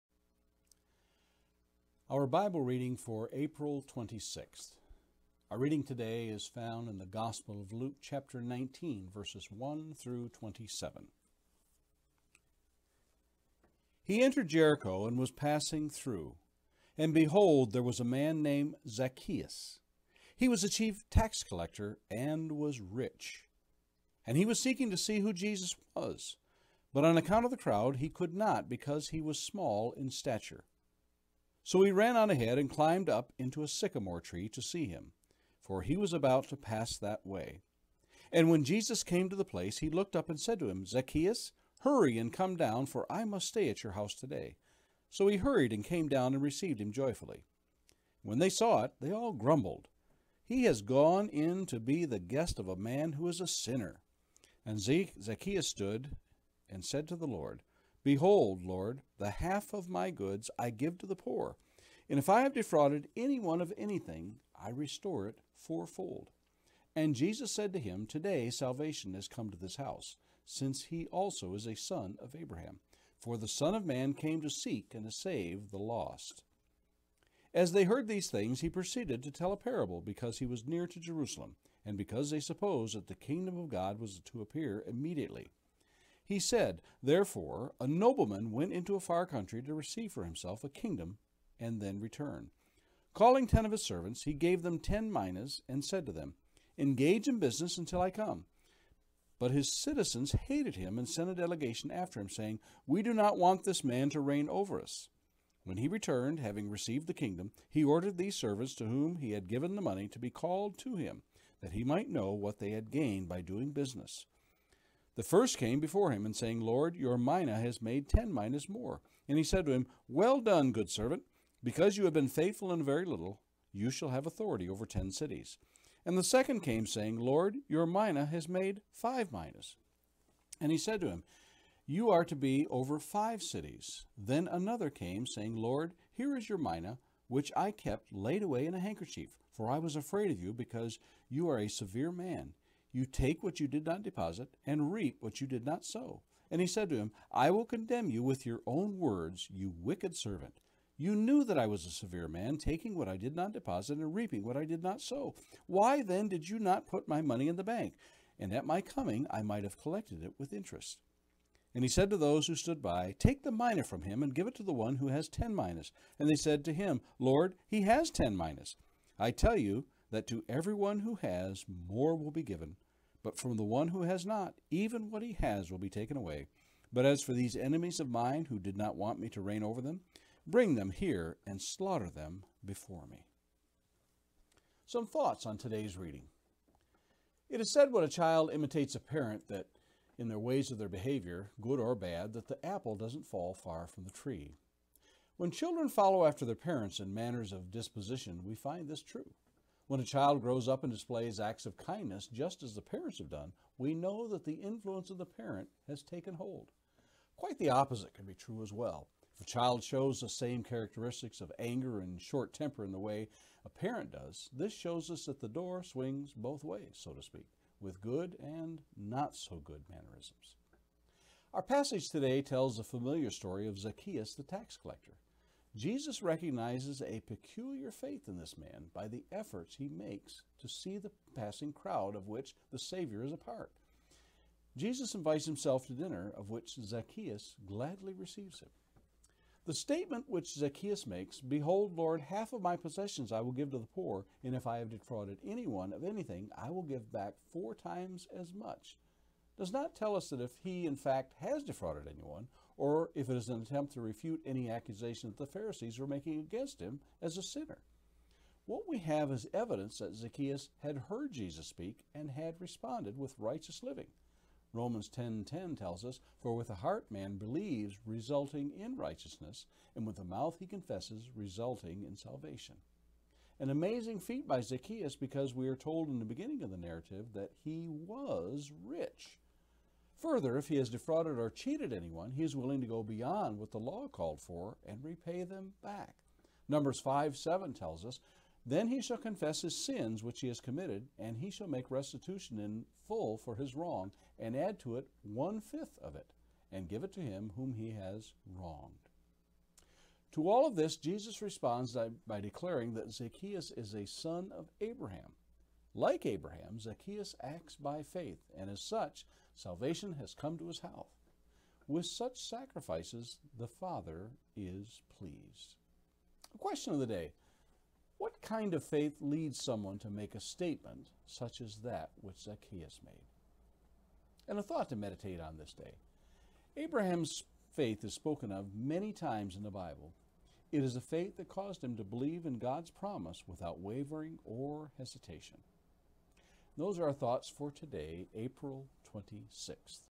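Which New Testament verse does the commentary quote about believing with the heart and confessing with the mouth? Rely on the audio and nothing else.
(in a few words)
Romans 10:10.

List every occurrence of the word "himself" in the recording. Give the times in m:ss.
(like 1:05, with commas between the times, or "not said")
1:30, 3:55.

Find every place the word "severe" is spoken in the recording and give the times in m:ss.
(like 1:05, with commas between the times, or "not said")
2:21, 2:31.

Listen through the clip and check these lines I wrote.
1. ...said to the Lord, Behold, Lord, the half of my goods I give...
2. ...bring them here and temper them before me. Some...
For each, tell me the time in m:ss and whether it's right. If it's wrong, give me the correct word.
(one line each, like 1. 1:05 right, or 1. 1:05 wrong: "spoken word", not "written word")
1. 0:56 right
2. 3:00 wrong: "slaughter", not "temper".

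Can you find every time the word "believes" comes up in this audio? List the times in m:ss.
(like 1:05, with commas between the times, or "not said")
4:27, 5:32.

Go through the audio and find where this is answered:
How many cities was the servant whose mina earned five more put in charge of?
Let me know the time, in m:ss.
2:11.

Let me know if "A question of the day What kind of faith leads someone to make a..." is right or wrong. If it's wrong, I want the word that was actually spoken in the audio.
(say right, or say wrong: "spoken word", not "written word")
right.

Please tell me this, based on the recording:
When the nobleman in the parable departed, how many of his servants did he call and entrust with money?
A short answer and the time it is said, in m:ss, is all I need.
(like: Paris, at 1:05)
10, at 1:33.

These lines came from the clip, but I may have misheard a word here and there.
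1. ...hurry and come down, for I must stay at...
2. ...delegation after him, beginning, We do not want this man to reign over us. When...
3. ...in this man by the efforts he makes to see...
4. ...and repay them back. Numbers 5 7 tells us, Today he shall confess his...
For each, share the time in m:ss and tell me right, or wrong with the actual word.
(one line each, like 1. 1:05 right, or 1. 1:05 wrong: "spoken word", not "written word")
1. 0:41 right
2. 1:41 wrong: "saying", not "beginning"
3. 3:48 right
4. 4:44 wrong: "Then", not "Today".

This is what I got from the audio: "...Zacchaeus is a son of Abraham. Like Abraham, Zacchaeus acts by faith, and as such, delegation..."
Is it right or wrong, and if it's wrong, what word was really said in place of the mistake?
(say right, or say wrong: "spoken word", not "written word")
wrong: "salvation", not "delegation".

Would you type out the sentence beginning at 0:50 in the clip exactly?
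He has gone in to be the guest of a man who is a sinner.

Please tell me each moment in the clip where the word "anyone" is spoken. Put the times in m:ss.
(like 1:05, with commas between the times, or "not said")
1:03, 4:05, 4:12, 4:41.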